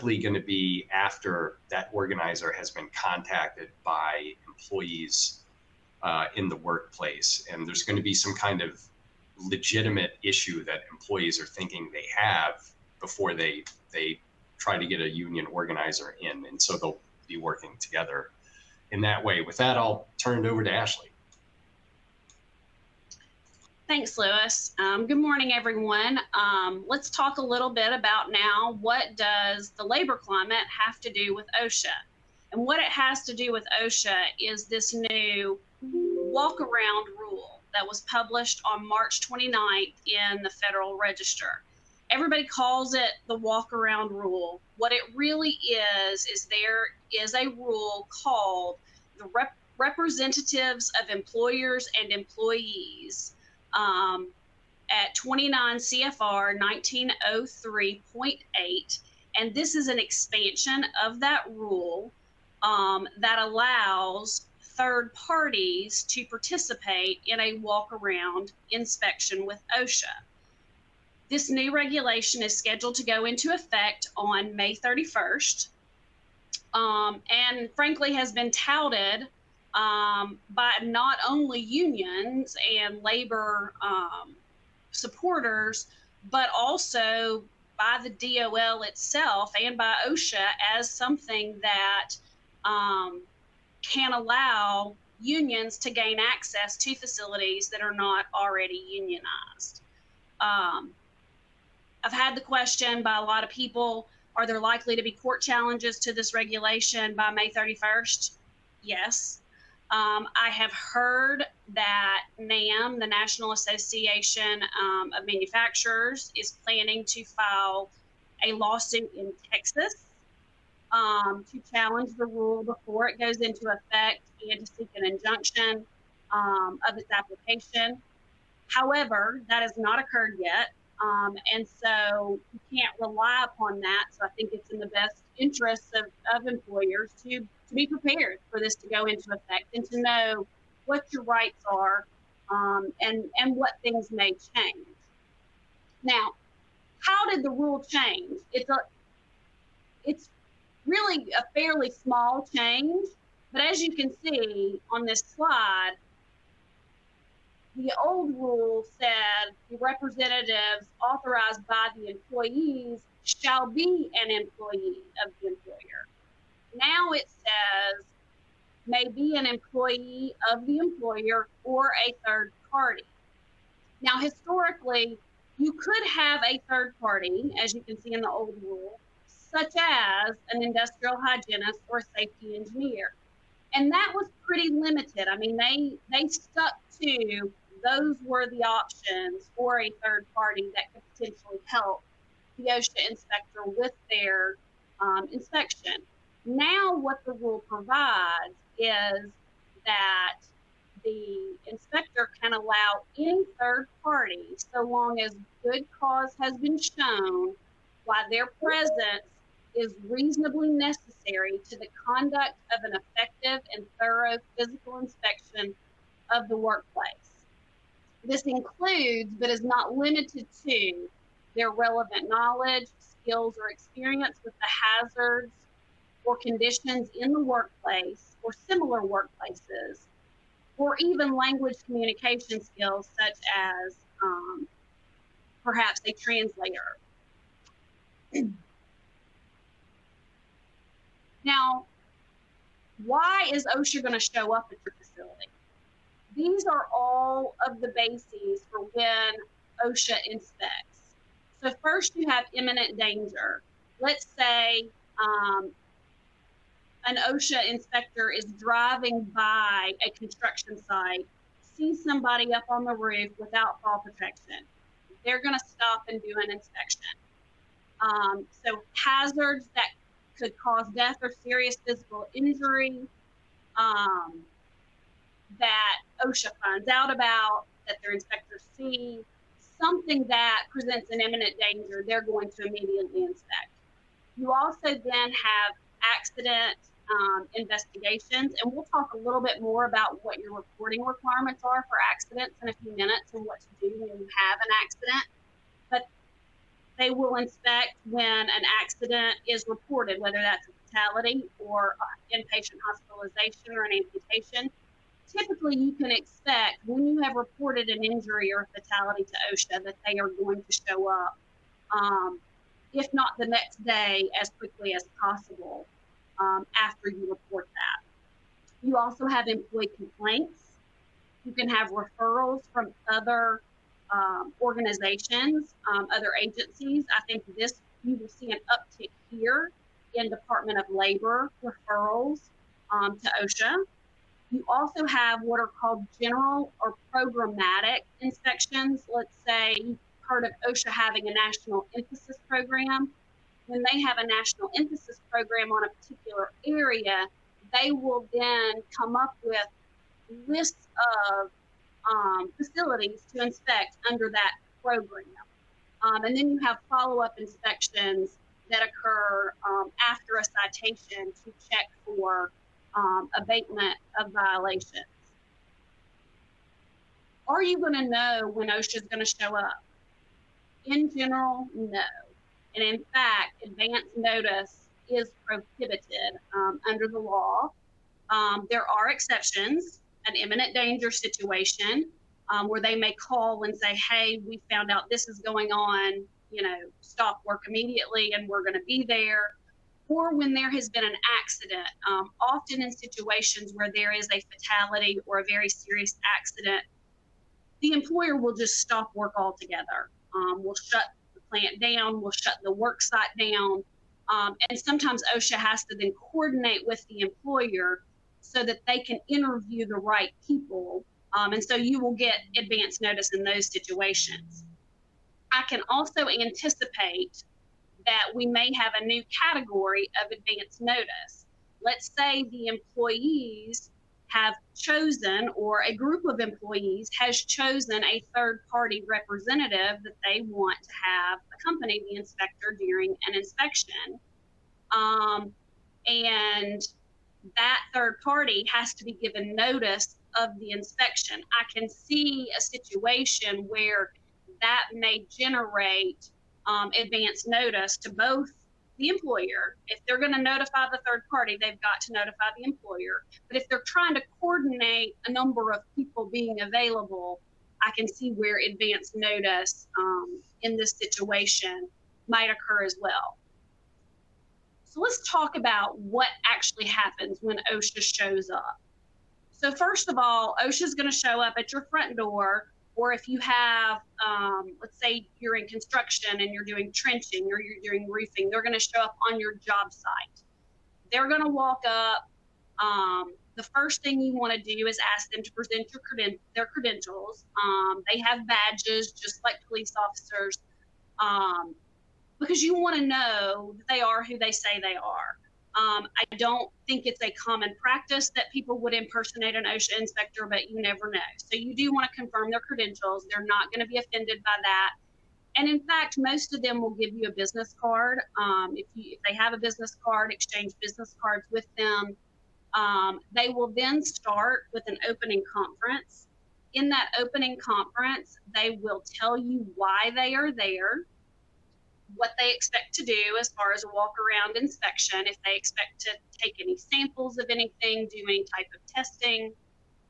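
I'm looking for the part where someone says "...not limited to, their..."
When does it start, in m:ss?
3:39.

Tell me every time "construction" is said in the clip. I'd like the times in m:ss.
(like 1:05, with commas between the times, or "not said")
4:20, 7:55.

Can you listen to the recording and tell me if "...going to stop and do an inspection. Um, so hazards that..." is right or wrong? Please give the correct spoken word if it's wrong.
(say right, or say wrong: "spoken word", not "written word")
right.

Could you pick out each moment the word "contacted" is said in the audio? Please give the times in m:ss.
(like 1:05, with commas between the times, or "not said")
0:02.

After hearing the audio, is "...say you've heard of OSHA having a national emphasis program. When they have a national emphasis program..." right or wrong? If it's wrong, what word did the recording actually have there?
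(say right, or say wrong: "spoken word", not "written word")
right.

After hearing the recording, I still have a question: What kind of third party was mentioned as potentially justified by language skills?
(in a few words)
A translator.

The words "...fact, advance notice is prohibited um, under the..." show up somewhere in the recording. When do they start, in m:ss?
6:13.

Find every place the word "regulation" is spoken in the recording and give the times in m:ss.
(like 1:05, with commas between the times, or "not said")
1:11, 1:46.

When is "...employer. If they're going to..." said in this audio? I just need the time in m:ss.
7:29.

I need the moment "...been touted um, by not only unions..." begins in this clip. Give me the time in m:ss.
1:18.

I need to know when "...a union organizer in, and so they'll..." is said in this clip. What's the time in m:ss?
0:14.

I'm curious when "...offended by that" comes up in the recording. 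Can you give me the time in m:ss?
8:23.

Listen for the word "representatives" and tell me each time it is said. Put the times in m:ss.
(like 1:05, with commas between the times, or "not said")
0:49, 2:39, 7:09.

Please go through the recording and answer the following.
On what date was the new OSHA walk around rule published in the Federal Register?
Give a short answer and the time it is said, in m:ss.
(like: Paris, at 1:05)
March 29th, at 0:38.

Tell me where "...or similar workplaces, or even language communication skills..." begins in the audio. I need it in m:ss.
3:48.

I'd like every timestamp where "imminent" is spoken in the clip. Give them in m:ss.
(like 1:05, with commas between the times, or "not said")
4:12, 4:41, 6:20.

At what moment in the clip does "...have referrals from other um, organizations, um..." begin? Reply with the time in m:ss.
5:21.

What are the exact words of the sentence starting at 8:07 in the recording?
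Um, they have badges, just like police officers.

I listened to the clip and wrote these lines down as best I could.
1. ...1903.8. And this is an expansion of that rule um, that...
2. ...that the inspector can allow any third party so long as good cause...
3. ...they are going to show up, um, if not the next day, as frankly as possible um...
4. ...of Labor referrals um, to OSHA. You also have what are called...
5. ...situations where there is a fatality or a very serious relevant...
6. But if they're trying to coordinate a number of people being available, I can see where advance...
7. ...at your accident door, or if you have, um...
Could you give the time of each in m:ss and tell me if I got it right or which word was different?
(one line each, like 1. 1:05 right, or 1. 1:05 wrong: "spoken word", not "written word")
1. 0:56 right
2. 3:19 right
3. 5:10 wrong: "quickly", not "frankly"
4. 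5:30 right
5. 6:32 wrong: "accident", not "relevant"
6. 7:33 right
7. 7:51 wrong: "front", not "accident".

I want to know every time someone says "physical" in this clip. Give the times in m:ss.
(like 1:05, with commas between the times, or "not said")
3:34, 4:31.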